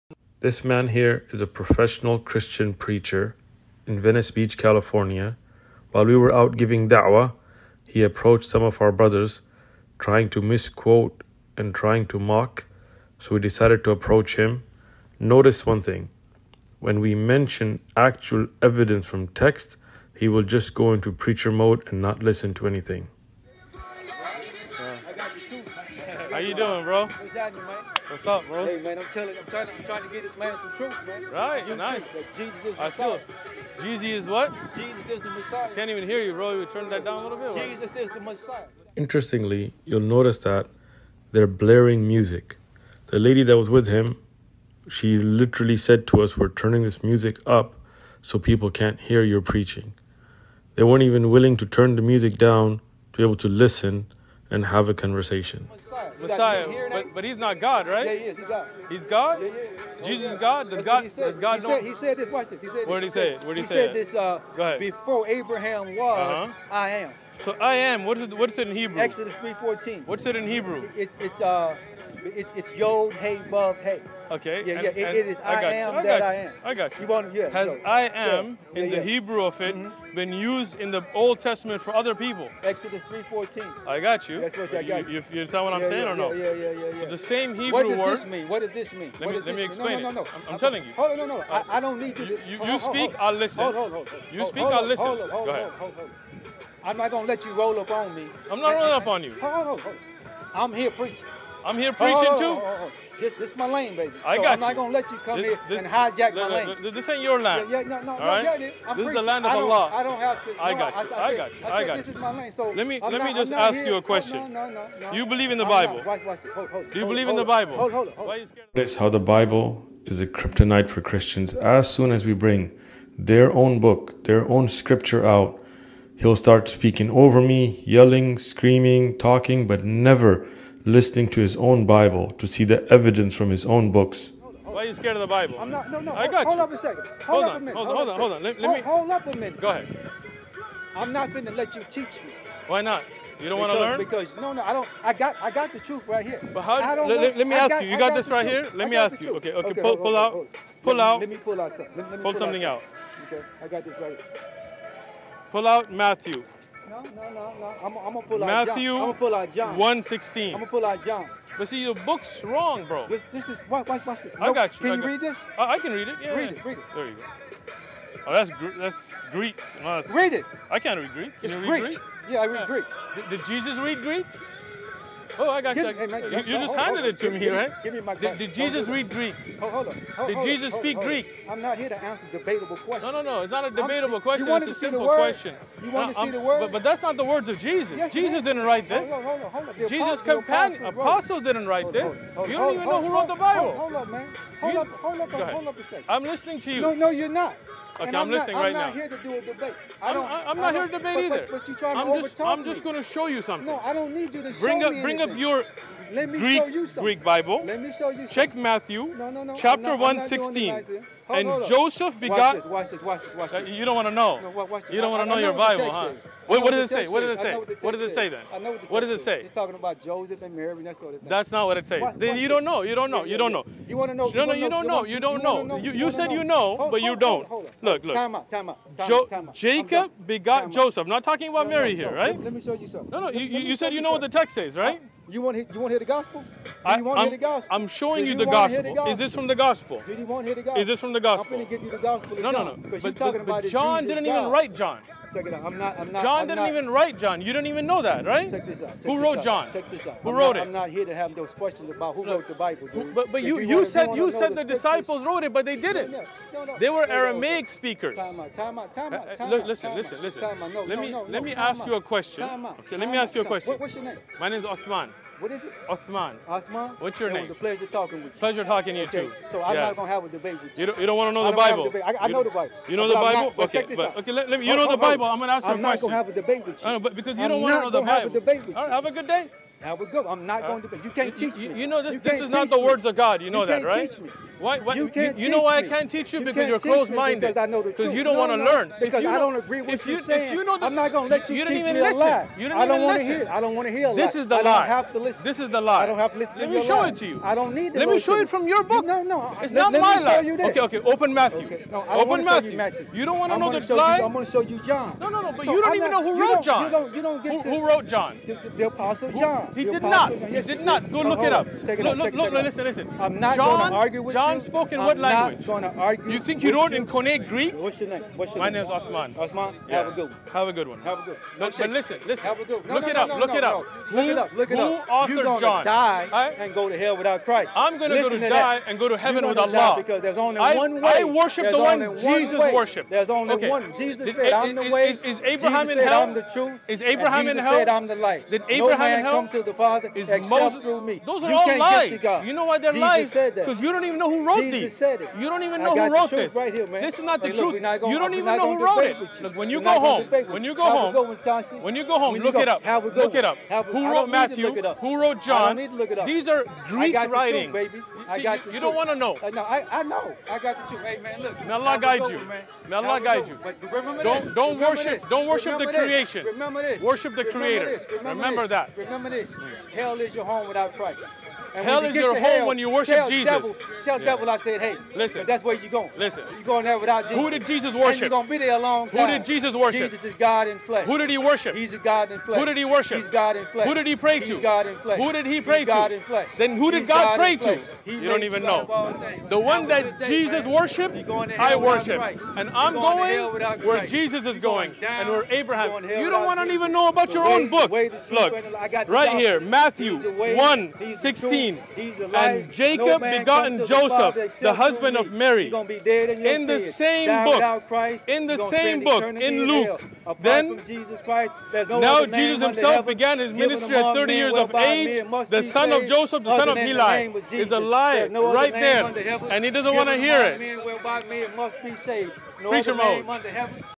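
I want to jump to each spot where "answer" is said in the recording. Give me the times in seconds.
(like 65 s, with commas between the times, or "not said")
182 s.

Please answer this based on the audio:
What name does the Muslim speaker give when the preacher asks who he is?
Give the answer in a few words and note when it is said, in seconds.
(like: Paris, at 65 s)
Othman, at 264 s.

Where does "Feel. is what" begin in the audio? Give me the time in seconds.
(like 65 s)
33 s.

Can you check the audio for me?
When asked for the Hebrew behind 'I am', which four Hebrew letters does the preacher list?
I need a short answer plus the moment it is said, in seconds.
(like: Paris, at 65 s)
Yod, Hey, Vav, Hey, at 72 s.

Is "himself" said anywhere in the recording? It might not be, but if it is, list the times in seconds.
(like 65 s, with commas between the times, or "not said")
412 s.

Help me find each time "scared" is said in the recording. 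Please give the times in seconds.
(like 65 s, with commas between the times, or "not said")
118 s, 134 s.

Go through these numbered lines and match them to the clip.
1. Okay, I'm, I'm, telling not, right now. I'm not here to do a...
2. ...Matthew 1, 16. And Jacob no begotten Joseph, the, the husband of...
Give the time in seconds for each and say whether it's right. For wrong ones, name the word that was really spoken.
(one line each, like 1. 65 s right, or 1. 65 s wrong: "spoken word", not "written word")
1. 198 s wrong: "listening", not "telling"
2. 399 s right.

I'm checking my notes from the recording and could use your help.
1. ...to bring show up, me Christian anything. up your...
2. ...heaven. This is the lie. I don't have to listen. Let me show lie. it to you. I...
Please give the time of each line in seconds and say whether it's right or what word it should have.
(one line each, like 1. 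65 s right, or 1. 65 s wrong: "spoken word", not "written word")
1. 204 s wrong: "Bring", not "Christian"
2. 295 s wrong: "listen", not "heaven".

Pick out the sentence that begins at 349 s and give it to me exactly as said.
Look, when you go home, when you go home, when you go home, look it up.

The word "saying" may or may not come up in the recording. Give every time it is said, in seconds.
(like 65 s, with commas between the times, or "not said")
85 s, 290 s.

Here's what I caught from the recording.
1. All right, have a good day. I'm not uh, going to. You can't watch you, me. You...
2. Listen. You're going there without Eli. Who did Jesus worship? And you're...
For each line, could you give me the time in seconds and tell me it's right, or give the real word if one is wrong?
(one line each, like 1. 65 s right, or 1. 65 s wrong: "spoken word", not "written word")
1. 278 s wrong: "teach", not "watch"
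2. 376 s wrong: "Jesus", not "Eli".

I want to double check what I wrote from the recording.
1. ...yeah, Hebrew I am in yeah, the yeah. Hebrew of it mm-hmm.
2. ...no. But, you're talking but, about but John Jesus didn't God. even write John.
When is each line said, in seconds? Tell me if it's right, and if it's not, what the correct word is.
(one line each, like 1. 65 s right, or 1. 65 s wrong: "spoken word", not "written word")
1. 77 s wrong: "Has", not "Hebrew"
2. 242 s right.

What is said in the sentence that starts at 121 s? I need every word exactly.
As soon as we bring their own book, their own scripture out.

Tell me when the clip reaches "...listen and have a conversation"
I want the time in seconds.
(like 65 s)
53 s.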